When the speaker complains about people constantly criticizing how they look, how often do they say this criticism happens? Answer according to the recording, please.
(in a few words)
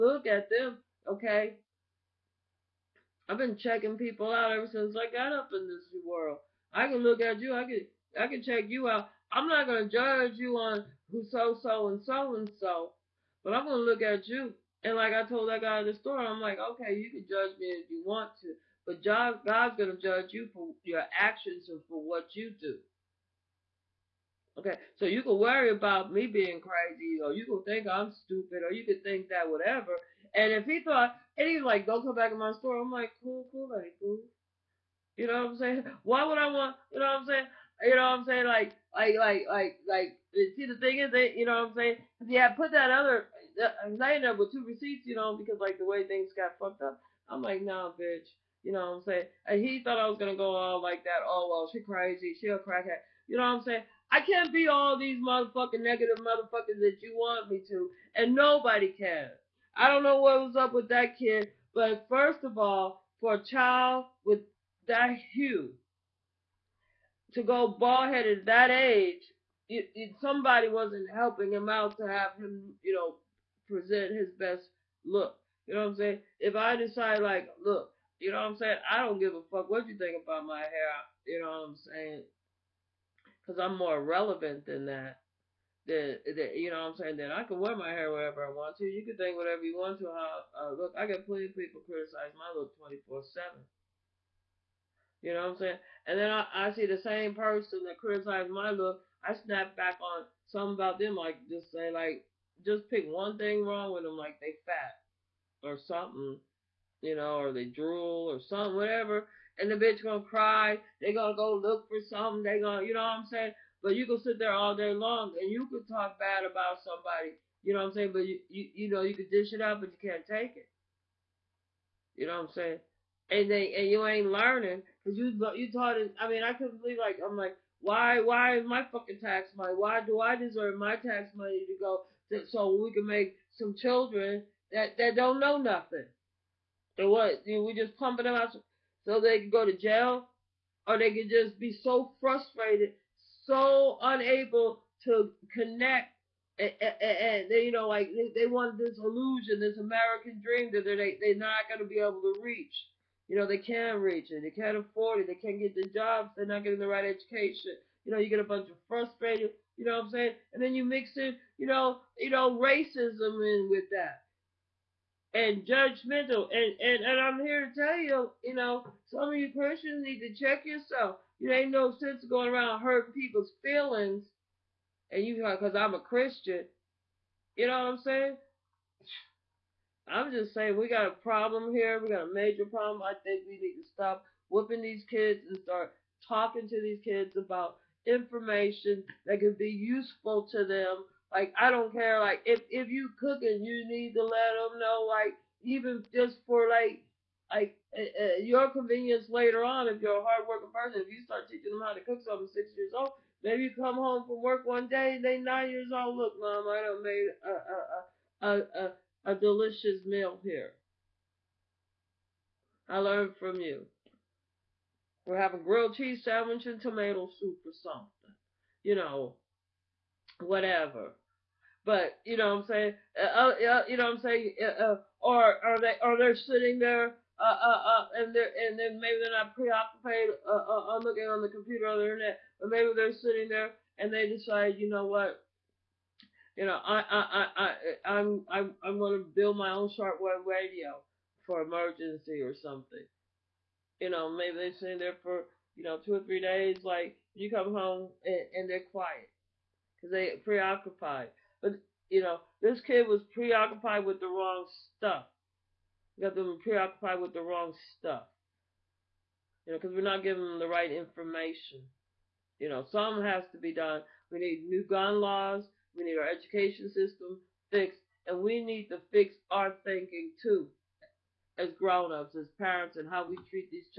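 24/7.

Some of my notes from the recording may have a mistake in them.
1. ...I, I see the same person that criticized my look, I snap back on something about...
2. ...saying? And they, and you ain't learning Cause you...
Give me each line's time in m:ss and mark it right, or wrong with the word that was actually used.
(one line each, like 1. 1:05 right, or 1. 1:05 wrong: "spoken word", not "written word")
1. 1:36 right
2. 2:02 right.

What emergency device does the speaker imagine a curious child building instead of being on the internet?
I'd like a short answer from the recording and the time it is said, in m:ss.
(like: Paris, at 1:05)
shortwave radio, at 3:59.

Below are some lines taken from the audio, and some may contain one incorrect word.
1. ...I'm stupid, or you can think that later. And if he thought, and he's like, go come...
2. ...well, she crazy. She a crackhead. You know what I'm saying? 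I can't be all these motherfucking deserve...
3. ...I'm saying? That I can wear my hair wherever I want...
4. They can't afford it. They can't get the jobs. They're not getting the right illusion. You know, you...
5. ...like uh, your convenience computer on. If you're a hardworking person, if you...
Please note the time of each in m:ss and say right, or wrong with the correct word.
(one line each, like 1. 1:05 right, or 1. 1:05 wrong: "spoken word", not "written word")
1. 0:27 wrong: "whatever", not "later"
2. 0:51 wrong: "negative", not "deserve"
3. 1:26 right
4. 2:34 wrong: "education", not "illusion"
5. 3:17 wrong: "later", not "computer".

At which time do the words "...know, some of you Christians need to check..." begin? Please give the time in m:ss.
2:48.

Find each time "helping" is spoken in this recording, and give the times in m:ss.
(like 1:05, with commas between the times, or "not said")
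1:11.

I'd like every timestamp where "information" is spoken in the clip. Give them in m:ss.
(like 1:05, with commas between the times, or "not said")
3:08, 4:20.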